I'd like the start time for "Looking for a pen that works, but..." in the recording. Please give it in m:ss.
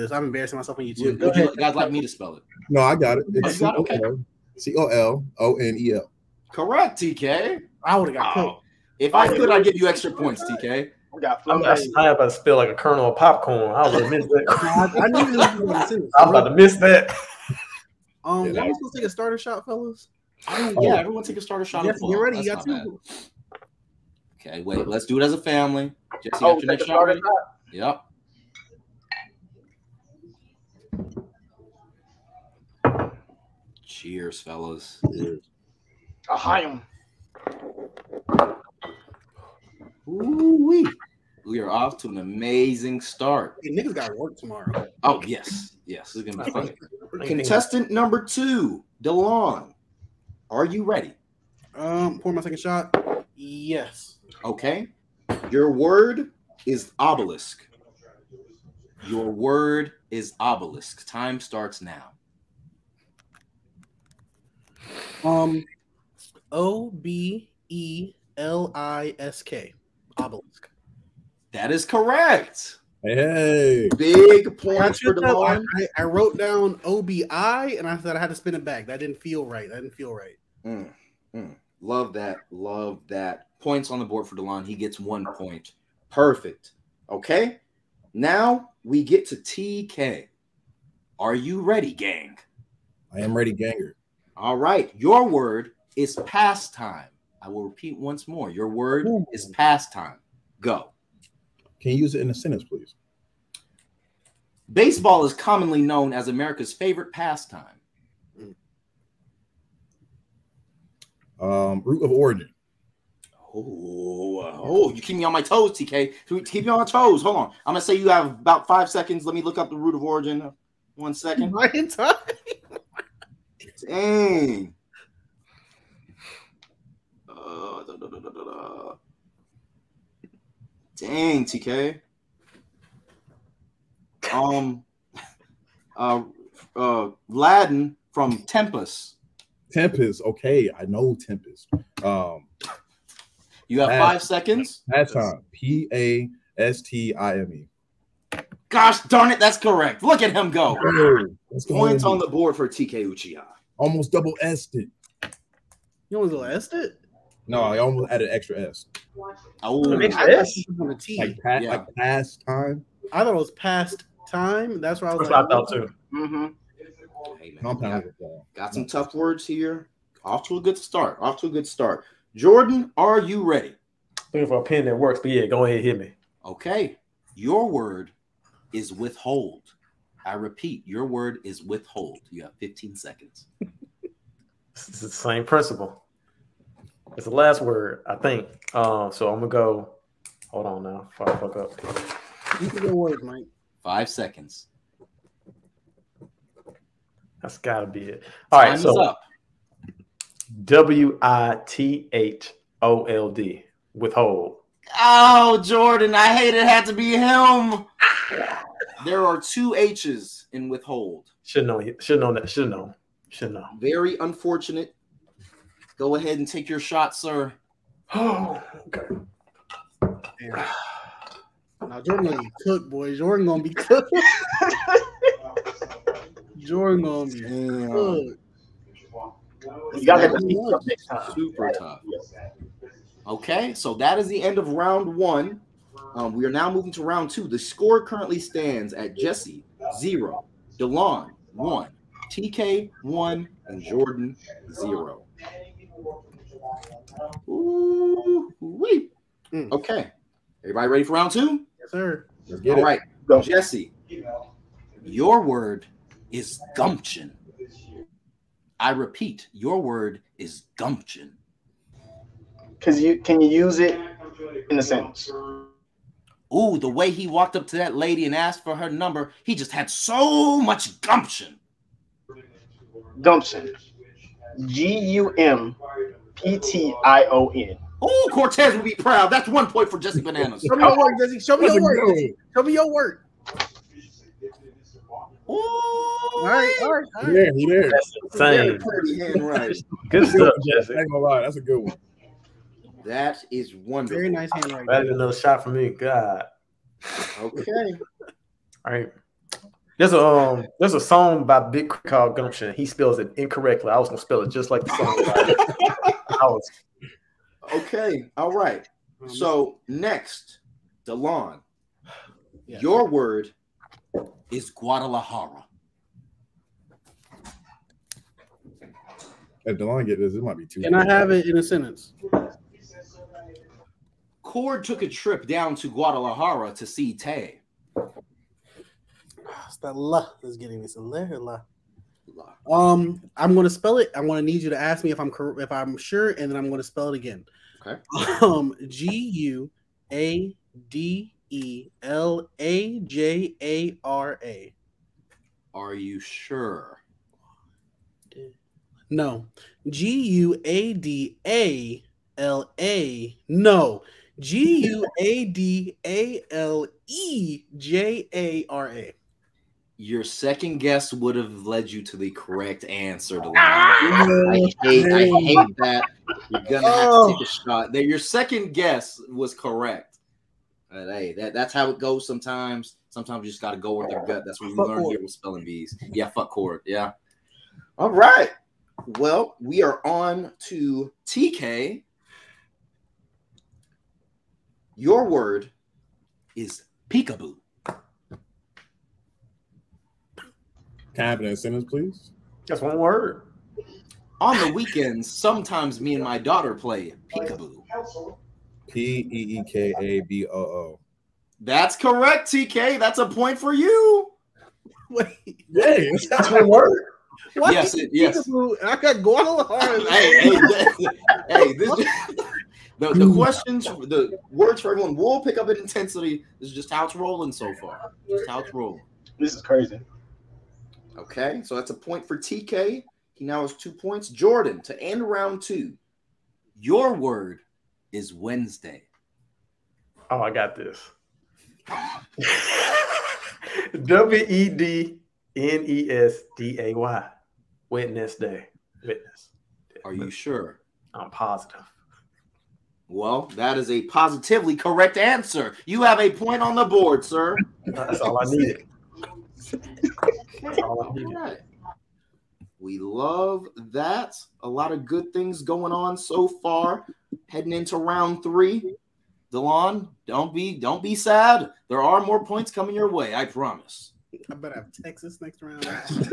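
2:54.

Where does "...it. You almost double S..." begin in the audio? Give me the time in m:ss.
2:34.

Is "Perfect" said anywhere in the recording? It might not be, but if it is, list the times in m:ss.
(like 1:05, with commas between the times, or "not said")
1:26.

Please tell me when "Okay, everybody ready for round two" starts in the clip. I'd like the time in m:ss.
4:09.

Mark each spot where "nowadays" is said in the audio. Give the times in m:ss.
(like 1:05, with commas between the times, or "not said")
not said.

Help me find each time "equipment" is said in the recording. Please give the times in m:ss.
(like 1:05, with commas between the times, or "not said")
not said.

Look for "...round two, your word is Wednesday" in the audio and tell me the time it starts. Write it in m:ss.
7:05.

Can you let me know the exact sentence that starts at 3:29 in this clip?
there are two H's in withhold.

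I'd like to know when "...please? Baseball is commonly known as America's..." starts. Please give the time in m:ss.
1:42.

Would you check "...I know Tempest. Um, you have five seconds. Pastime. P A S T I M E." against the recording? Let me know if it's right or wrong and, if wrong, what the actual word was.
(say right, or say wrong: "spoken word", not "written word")
right.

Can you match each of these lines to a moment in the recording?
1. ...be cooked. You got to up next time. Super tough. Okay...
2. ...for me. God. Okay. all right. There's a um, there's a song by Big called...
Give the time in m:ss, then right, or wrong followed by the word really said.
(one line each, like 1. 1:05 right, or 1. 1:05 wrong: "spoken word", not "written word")
1. 3:47 right
2. 4:55 right.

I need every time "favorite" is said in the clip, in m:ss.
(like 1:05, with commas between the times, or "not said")
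1:46.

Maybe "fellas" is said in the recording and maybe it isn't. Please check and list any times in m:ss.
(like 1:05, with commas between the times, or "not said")
0:19, 0:34.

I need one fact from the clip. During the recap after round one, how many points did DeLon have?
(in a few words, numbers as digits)
1.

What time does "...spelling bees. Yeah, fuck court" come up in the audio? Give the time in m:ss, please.
6:15.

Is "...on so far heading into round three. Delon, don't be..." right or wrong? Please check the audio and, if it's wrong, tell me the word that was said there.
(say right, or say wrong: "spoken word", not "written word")
right.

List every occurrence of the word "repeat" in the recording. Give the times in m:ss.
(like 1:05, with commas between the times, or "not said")
1:37, 3:00, 4:18.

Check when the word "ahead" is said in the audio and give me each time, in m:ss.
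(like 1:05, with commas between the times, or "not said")
2:55, 3:36.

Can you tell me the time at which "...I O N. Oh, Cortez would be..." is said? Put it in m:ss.
4:37.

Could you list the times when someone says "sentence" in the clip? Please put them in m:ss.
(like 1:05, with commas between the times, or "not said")
1:42, 4:24, 5:21, 6:31.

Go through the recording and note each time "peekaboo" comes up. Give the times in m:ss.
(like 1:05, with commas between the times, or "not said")
6:27, 6:37.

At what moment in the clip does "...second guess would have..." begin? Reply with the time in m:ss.
6:00.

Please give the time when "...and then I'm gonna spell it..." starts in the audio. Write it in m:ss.
5:36.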